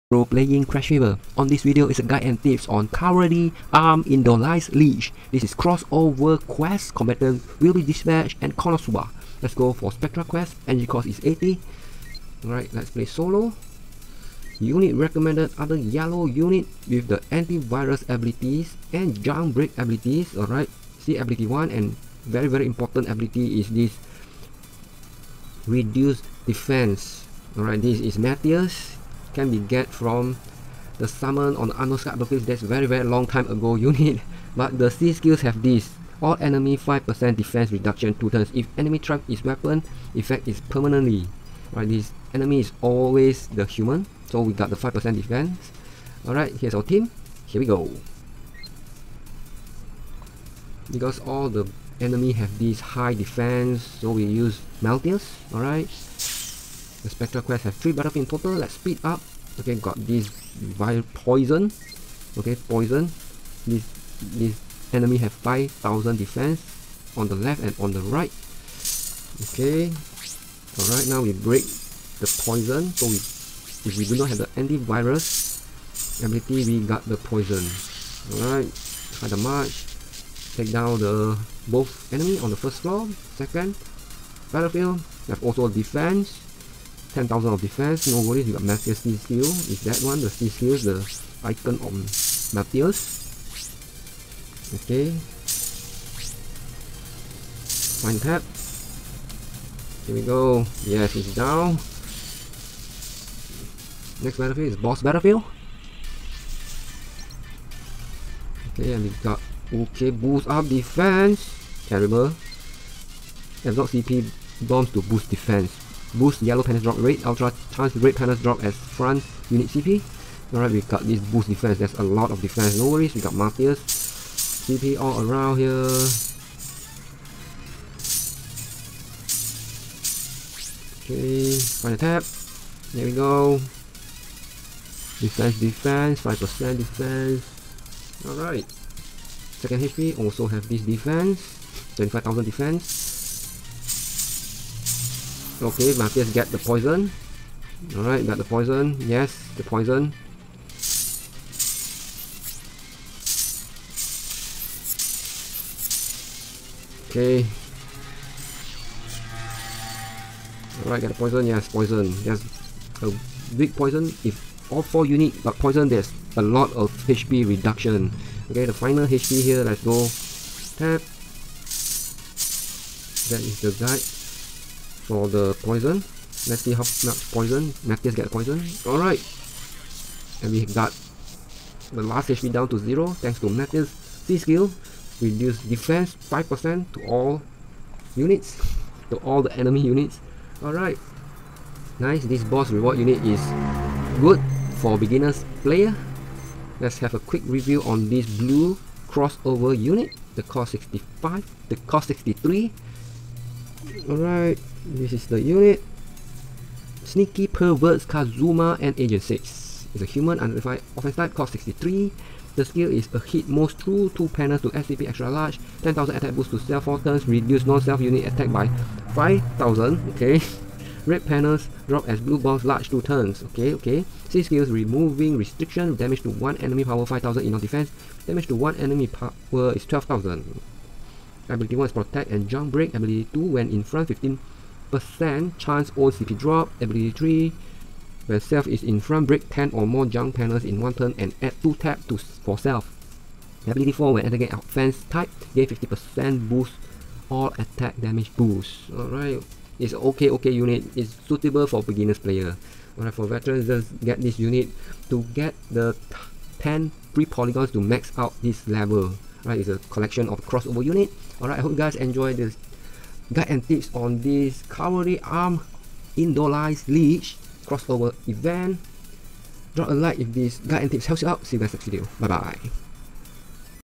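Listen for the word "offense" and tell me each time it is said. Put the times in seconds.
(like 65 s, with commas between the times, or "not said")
210 s, 244 s.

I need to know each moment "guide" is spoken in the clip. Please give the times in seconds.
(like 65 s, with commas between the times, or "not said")
2 s, 173 s, 263 s, 270 s.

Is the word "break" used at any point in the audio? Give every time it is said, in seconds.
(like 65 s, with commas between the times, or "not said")
19 s, 71 s, 232 s, 239 s.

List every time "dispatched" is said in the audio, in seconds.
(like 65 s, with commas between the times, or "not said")
7 s.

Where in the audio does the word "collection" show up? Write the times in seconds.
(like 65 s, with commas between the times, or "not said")
259 s.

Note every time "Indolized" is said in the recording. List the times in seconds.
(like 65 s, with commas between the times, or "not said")
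4 s, 266 s.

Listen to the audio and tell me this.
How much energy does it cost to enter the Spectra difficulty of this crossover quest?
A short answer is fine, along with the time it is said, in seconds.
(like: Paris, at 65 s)
80, at 10 s.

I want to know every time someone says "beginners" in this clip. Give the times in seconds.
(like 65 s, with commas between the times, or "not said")
194 s, 251 s.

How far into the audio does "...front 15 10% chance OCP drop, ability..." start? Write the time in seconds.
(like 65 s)
233 s.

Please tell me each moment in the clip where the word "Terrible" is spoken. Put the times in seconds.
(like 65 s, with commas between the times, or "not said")
111 s.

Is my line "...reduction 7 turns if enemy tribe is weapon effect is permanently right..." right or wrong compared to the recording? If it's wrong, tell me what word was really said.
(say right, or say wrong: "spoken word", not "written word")
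wrong: "2", not "7".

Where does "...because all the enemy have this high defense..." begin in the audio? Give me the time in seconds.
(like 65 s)
50 s.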